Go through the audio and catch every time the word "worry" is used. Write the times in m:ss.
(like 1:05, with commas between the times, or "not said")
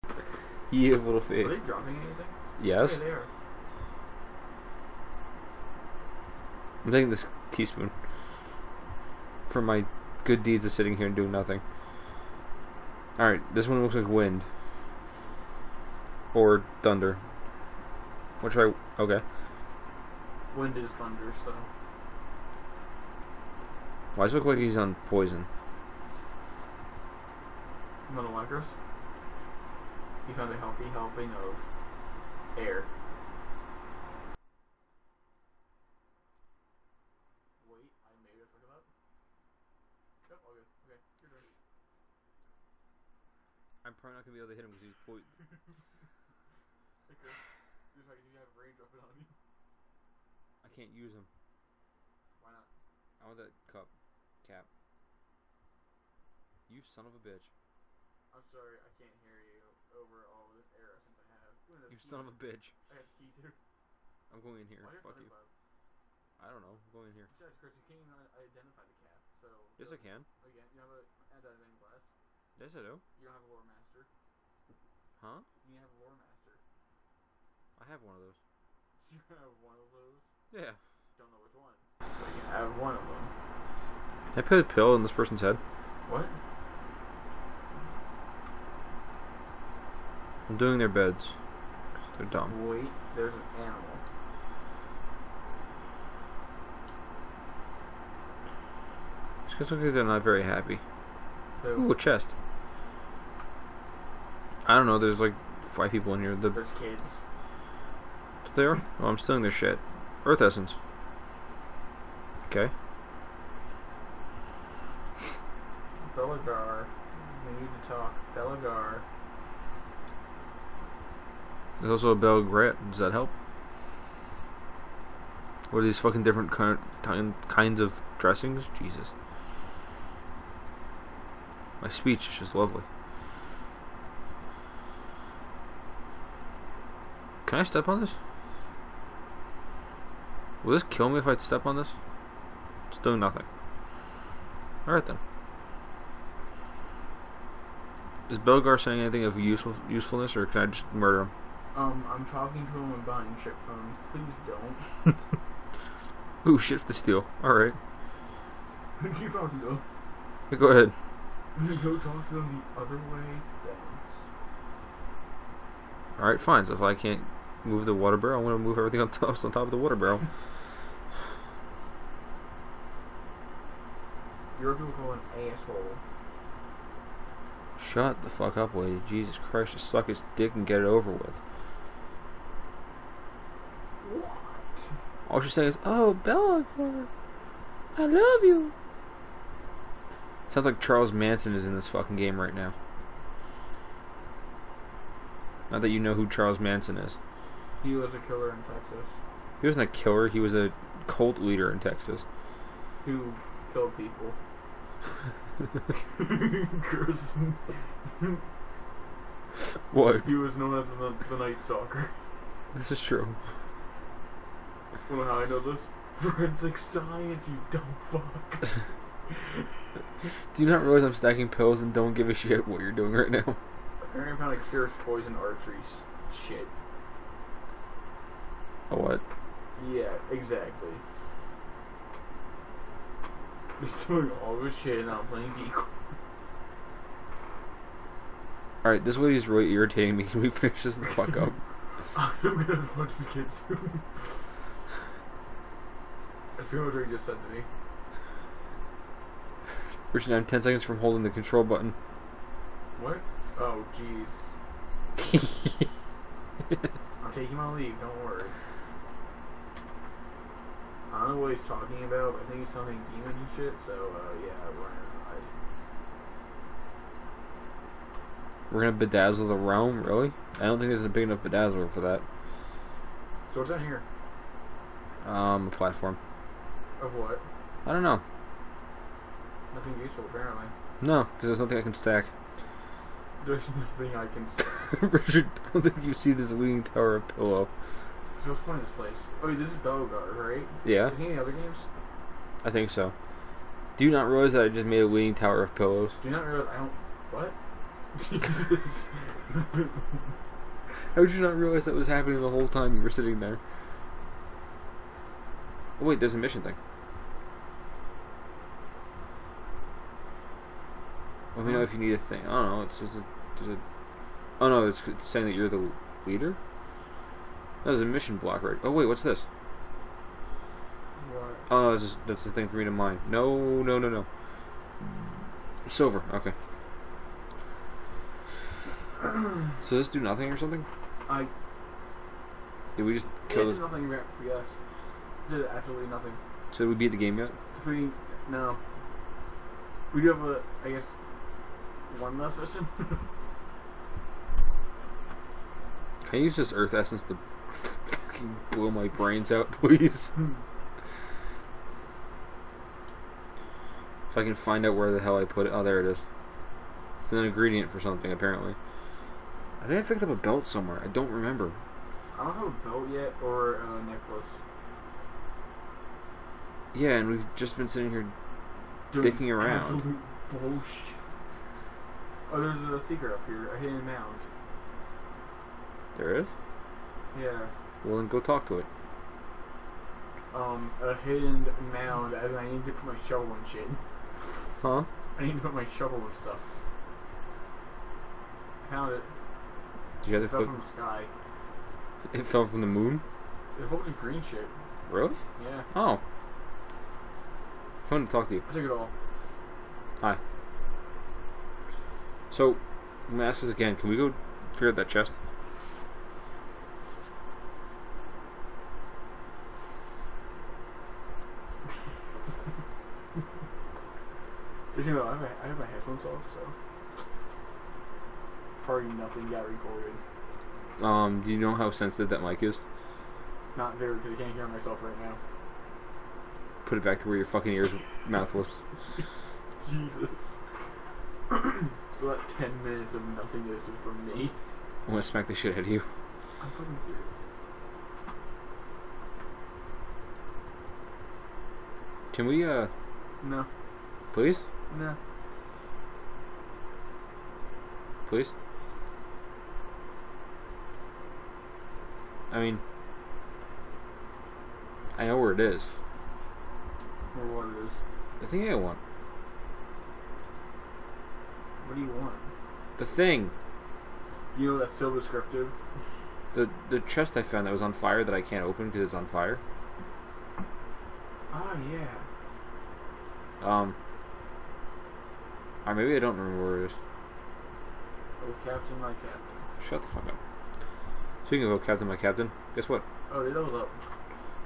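4:18.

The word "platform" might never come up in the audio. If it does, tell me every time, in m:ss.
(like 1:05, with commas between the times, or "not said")
4:35.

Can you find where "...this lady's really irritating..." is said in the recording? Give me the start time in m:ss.
3:59.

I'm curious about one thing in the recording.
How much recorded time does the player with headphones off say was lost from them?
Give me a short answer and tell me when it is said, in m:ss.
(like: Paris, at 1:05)
10 minutes, at 7:12.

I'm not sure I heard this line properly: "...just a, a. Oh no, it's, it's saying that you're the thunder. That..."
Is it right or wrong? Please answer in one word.
wrong.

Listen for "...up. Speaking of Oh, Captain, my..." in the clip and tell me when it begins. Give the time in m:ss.
8:00.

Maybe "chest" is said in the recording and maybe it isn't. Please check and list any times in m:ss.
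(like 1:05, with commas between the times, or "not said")
1:41, 6:45, 7:47.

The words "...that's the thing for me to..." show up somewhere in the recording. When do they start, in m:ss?
5:22.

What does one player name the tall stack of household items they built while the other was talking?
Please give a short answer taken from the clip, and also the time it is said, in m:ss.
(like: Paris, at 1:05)
Leaning Tower of Pillows, at 4:55.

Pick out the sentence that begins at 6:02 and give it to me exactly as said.
I don't have a belt yet or a necklace.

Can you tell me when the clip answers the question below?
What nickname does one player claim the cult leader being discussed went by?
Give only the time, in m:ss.
3:31.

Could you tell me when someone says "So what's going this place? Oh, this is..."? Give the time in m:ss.
4:48.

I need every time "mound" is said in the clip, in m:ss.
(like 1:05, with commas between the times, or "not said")
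6:14, 6:21.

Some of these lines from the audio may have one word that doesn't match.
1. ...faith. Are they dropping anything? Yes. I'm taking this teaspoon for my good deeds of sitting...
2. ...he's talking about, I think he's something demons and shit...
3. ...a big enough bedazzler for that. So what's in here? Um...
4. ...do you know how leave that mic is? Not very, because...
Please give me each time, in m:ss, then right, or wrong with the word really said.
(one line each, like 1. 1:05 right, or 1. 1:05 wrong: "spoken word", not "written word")
1. 0:01 right
2. 4:21 right
3. 4:31 right
4. 7:01 wrong: "sensitive", not "leave".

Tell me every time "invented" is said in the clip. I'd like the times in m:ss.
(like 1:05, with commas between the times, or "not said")
not said.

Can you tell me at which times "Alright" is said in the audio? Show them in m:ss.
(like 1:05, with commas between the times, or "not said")
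0:13, 2:24, 2:37, 2:46, 3:58.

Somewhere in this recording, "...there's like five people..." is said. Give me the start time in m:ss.
1:44.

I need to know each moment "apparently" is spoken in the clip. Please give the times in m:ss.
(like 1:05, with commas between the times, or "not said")
3:44, 4:40, 5:58.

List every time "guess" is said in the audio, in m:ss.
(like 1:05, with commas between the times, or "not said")
5:40, 8:02.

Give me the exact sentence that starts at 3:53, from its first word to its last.
He's doing all this shit and I'm playing decoy.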